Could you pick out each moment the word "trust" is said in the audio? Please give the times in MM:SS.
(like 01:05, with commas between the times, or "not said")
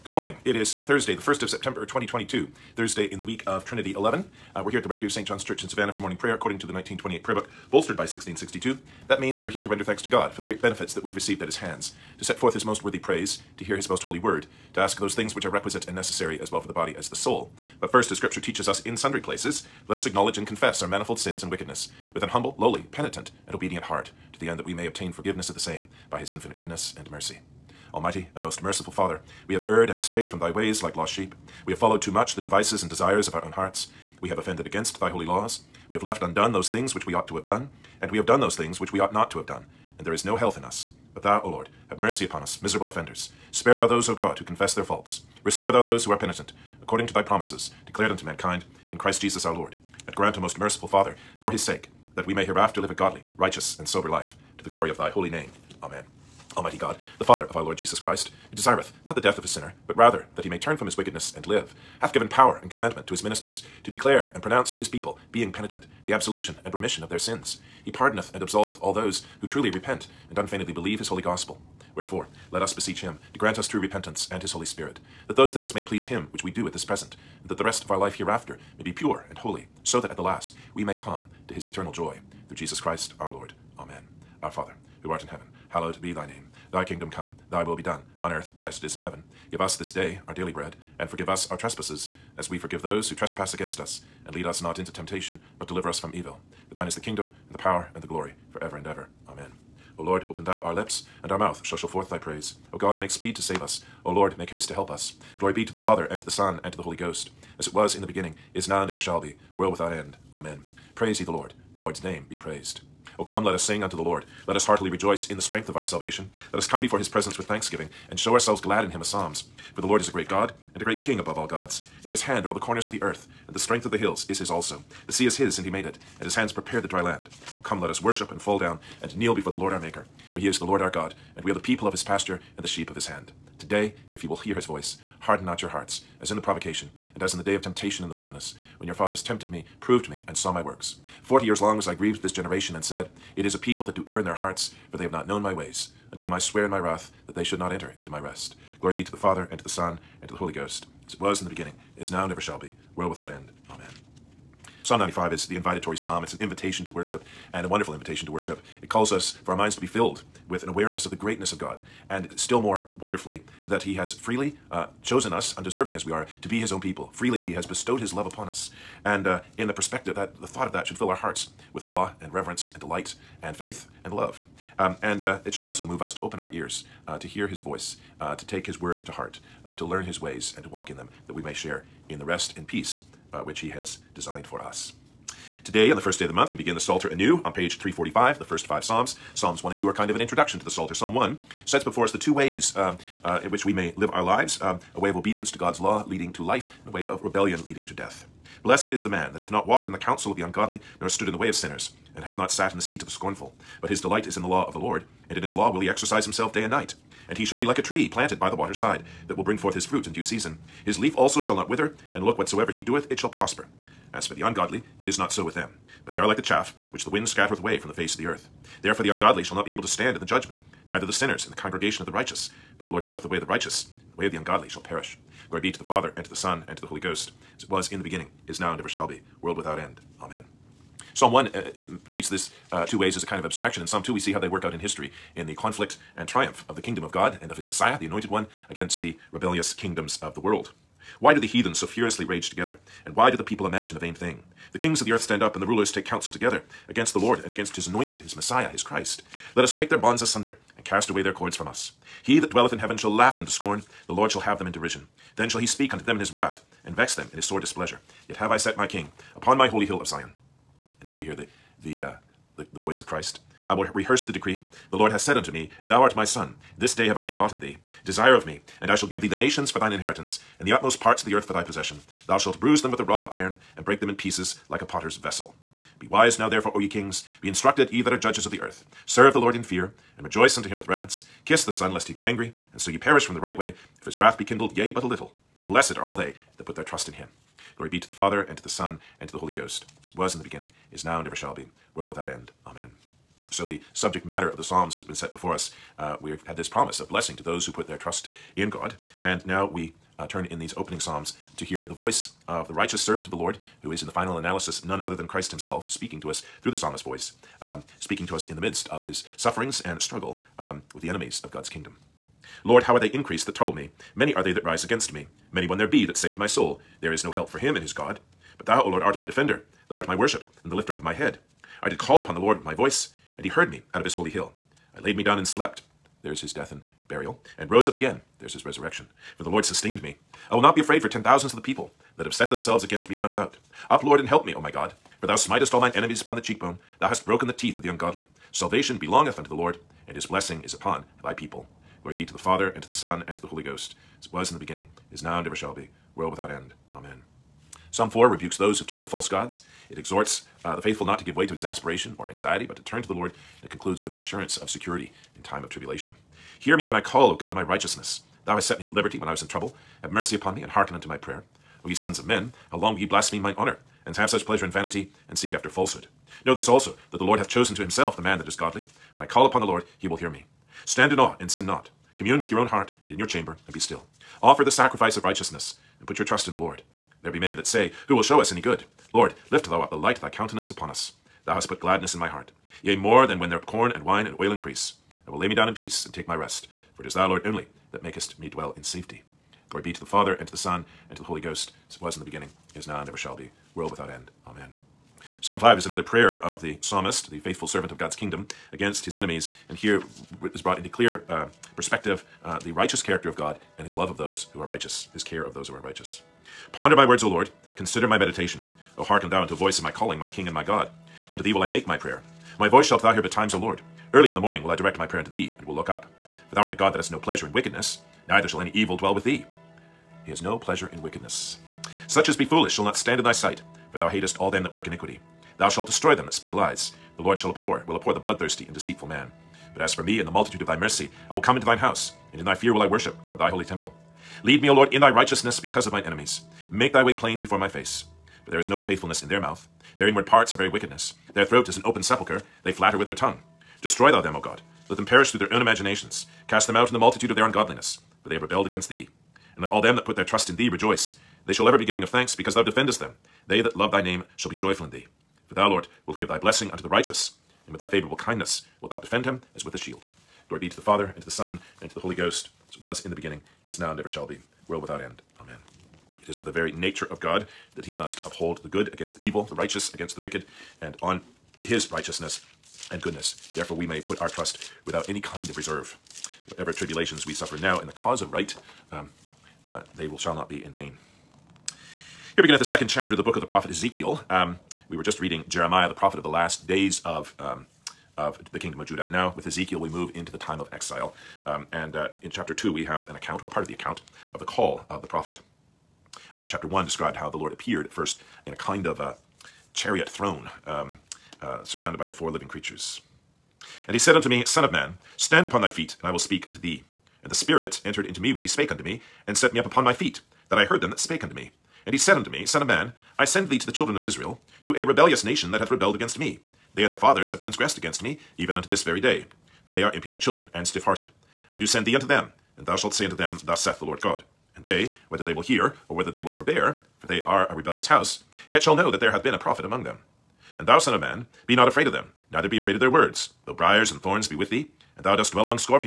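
04:46, 04:57, 06:16, 07:30, 07:54.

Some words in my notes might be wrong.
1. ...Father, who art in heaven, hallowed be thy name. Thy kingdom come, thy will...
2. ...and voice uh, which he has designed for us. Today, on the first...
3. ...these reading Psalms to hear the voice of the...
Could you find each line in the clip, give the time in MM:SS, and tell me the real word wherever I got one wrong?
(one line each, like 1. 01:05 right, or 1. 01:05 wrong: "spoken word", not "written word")
1. 01:24 right
2. 03:02 wrong: "peace", not "voice"
3. 05:00 wrong: "opening", not "reading".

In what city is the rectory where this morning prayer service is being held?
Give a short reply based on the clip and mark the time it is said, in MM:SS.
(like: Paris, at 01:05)
Savannah, at 00:05.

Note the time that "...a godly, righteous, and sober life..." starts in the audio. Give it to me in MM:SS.
00:52.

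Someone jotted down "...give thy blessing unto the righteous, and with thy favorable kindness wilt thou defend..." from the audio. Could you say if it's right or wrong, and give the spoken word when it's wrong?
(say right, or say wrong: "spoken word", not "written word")
right.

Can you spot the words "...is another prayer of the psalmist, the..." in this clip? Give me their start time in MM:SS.
06:35.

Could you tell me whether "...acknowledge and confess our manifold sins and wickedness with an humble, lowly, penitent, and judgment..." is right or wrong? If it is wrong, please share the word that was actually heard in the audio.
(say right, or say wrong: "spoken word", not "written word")
wrong: "obedient", not "judgment".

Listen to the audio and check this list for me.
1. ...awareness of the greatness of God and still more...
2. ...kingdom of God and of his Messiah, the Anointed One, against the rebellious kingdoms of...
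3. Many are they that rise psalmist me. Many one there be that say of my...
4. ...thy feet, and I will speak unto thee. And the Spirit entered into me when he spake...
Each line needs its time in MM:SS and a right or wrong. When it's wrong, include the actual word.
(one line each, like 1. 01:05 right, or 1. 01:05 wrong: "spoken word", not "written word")
1. 02:40 right
2. 03:56 right
3. 05:14 wrong: "against", not "psalmist"
4. 08:25 right.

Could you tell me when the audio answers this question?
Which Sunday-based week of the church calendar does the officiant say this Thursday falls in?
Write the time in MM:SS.
00:03.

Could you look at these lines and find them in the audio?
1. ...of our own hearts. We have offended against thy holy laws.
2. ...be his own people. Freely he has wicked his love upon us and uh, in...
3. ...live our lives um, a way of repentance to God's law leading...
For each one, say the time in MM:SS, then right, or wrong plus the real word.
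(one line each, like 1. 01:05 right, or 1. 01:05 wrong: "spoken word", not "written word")
1. 00:33 right
2. 02:46 wrong: "bestowed", not "wicked"
3. 03:13 wrong: "obedience", not "repentance".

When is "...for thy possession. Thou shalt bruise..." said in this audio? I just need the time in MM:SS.
04:31.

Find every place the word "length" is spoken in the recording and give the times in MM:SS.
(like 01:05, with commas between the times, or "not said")
not said.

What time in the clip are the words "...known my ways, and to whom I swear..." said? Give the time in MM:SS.
02:25.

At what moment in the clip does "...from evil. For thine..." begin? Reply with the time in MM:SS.
01:35.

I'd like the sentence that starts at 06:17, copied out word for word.
There be many that say, Who will show us any good?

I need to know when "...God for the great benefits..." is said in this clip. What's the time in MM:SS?
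00:10.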